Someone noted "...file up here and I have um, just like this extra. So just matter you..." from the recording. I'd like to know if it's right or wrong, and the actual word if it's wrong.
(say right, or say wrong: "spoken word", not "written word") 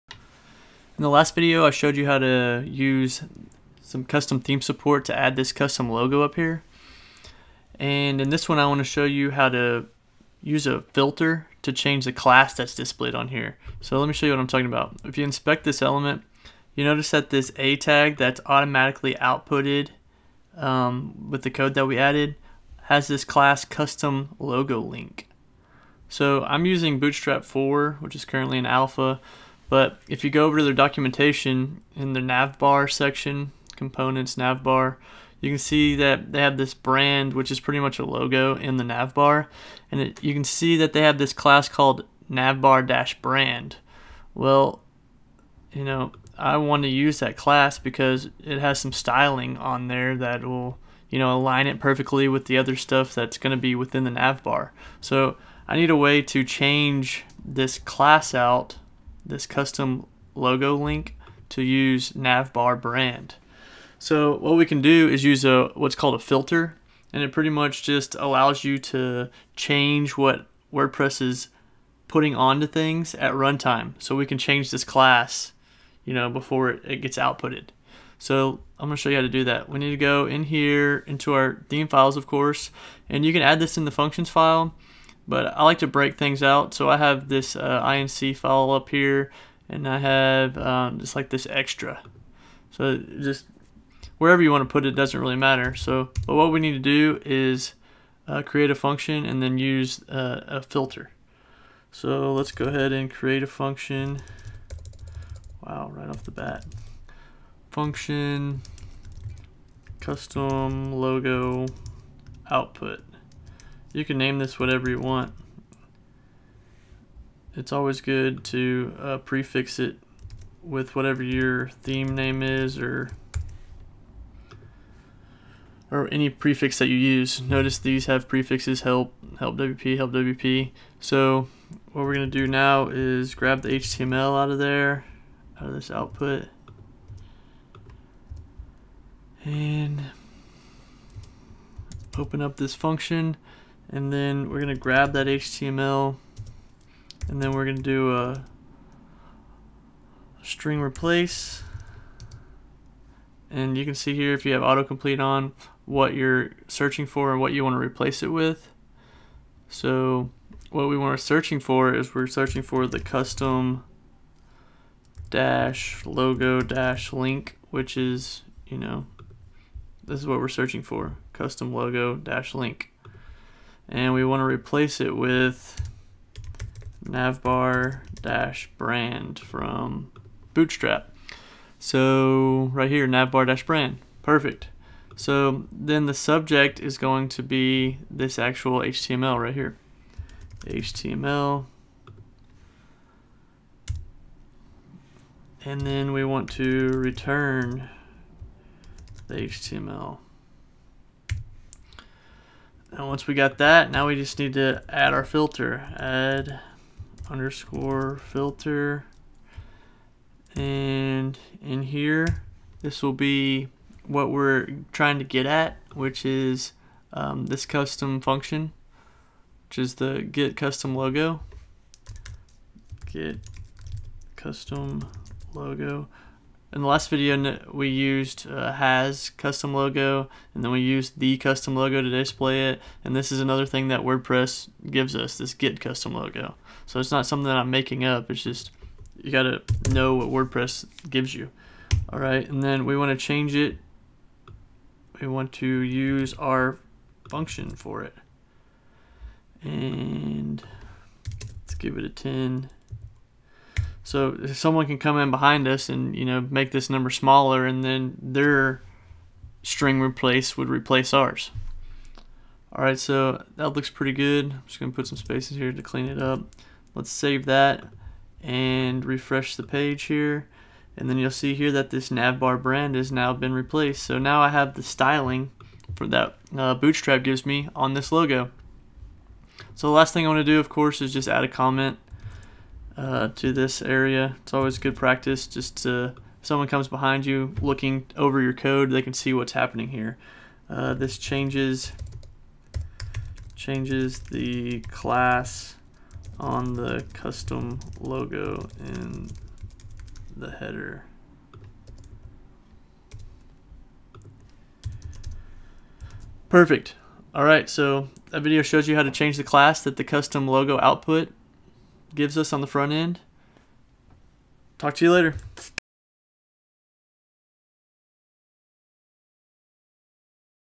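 wrong: "wherever", not "matter".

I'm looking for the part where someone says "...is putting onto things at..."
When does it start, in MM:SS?
01:11.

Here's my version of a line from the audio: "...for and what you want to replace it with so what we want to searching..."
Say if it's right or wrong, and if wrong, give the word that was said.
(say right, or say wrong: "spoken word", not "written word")
right.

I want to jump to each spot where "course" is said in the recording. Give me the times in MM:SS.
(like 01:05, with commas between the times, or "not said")
01:22, 04:40.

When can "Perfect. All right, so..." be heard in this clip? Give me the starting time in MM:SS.
05:06.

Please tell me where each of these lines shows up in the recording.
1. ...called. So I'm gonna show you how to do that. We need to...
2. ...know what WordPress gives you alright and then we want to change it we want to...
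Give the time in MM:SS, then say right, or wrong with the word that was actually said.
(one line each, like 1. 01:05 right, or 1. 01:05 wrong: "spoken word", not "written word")
1. 01:17 wrong: "outputted", not "called"
2. 03:59 right.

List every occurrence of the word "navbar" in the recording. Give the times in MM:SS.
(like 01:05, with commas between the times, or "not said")
00:42, 01:02, 02:57, 03:03, 04:32.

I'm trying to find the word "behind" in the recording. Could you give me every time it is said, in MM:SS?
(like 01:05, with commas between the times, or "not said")
04:15, 04:46.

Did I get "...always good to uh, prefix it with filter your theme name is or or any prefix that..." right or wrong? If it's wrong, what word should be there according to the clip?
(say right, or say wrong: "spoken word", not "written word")
wrong: "whatever", not "filter".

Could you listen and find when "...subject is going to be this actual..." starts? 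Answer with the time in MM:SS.
03:06.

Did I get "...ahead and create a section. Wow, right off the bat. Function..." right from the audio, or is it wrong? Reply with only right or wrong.
wrong.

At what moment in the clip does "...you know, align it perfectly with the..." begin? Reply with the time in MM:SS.
00:51.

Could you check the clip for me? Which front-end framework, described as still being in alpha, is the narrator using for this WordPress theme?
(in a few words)
Bootstrap 4.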